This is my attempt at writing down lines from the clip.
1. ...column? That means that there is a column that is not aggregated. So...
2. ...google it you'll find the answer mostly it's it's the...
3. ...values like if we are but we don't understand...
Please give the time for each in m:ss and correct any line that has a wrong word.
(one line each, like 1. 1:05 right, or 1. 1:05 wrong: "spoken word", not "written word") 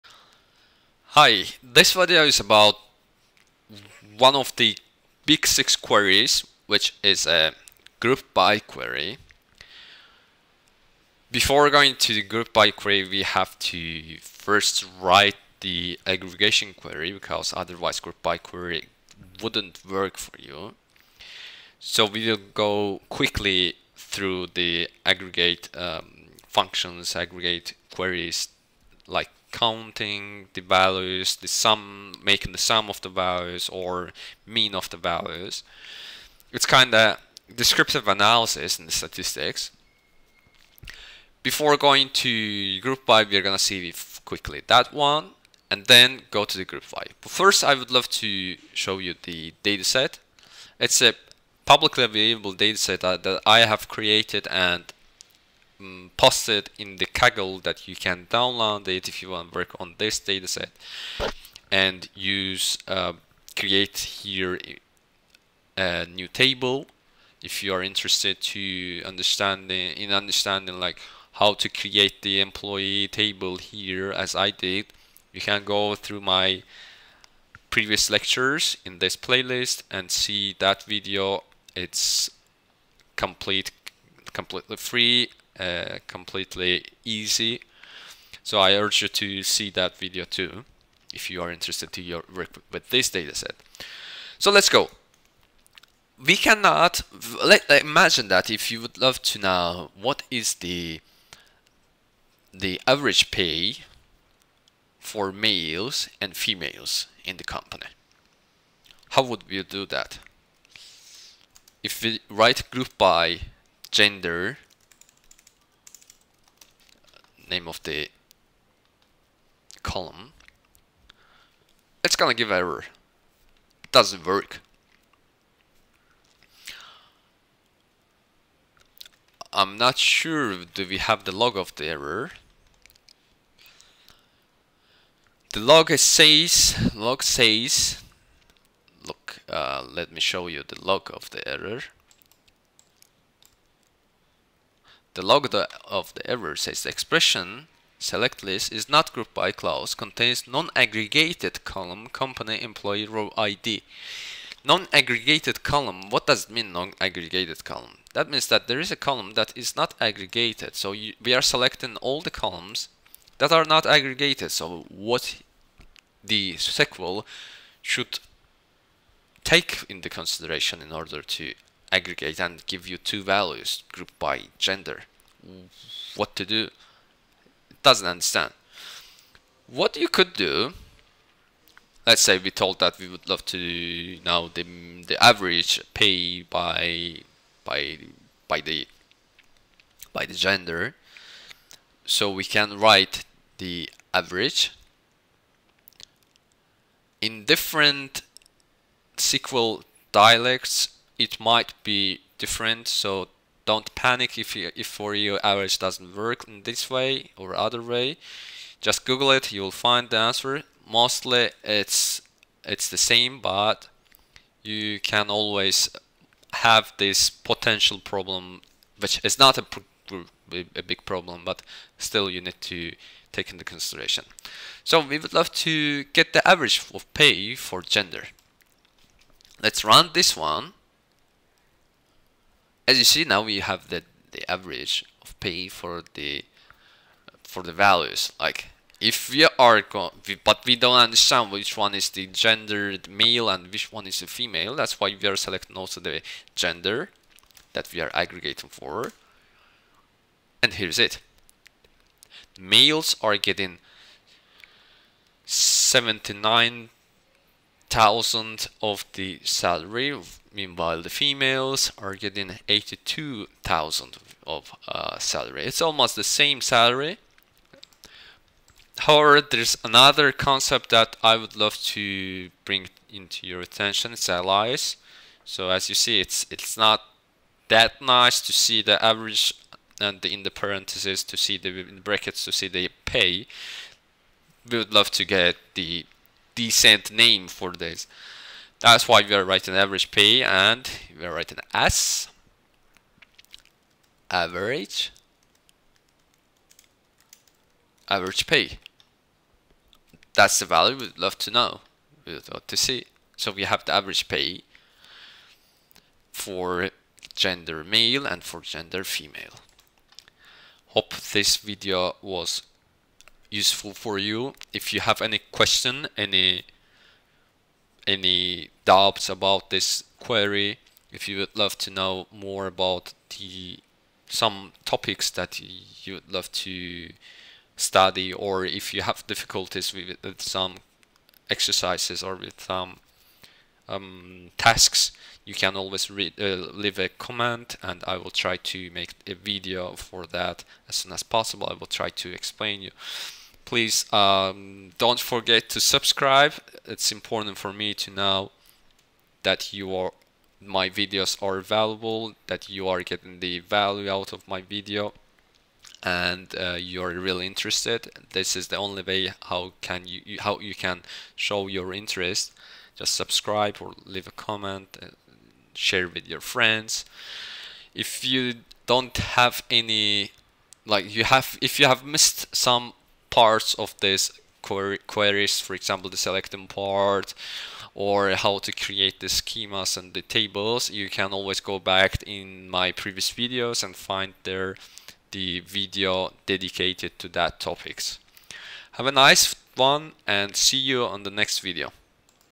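1. 2:37 right
2. 3:29 right
3. 3:57 right.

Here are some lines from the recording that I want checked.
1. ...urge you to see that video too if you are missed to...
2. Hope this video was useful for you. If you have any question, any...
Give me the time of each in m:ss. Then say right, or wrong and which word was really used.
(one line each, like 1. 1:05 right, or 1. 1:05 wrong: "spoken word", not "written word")
1. 1:28 wrong: "interested", not "missed"
2. 5:10 right.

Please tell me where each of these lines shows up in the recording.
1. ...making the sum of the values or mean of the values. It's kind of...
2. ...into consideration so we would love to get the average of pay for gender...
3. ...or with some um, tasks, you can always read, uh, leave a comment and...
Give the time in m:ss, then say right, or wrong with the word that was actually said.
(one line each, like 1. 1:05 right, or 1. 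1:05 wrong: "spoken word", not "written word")
1. 0:32 right
2. 3:43 right
3. 5:32 right.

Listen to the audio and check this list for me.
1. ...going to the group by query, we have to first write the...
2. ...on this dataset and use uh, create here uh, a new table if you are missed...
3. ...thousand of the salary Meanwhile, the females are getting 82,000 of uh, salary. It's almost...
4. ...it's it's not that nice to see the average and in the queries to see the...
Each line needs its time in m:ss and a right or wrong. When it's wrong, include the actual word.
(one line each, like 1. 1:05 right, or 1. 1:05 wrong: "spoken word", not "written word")
1. 0:11 right
2. 0:59 wrong: "interested", not "missed"
3. 4:17 right
4. 4:36 wrong: "parentheses", not "queries".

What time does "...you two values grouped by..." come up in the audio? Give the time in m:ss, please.
2:52.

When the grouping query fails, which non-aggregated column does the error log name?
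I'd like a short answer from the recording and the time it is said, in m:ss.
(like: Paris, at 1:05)
company employee row ID, at 2:32.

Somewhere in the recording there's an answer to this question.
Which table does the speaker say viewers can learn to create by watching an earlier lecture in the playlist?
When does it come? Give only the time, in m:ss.
1:12.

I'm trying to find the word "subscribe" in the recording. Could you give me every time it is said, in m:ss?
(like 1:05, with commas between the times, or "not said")
5:45, 6:03.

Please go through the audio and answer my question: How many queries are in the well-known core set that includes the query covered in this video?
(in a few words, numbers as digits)
6.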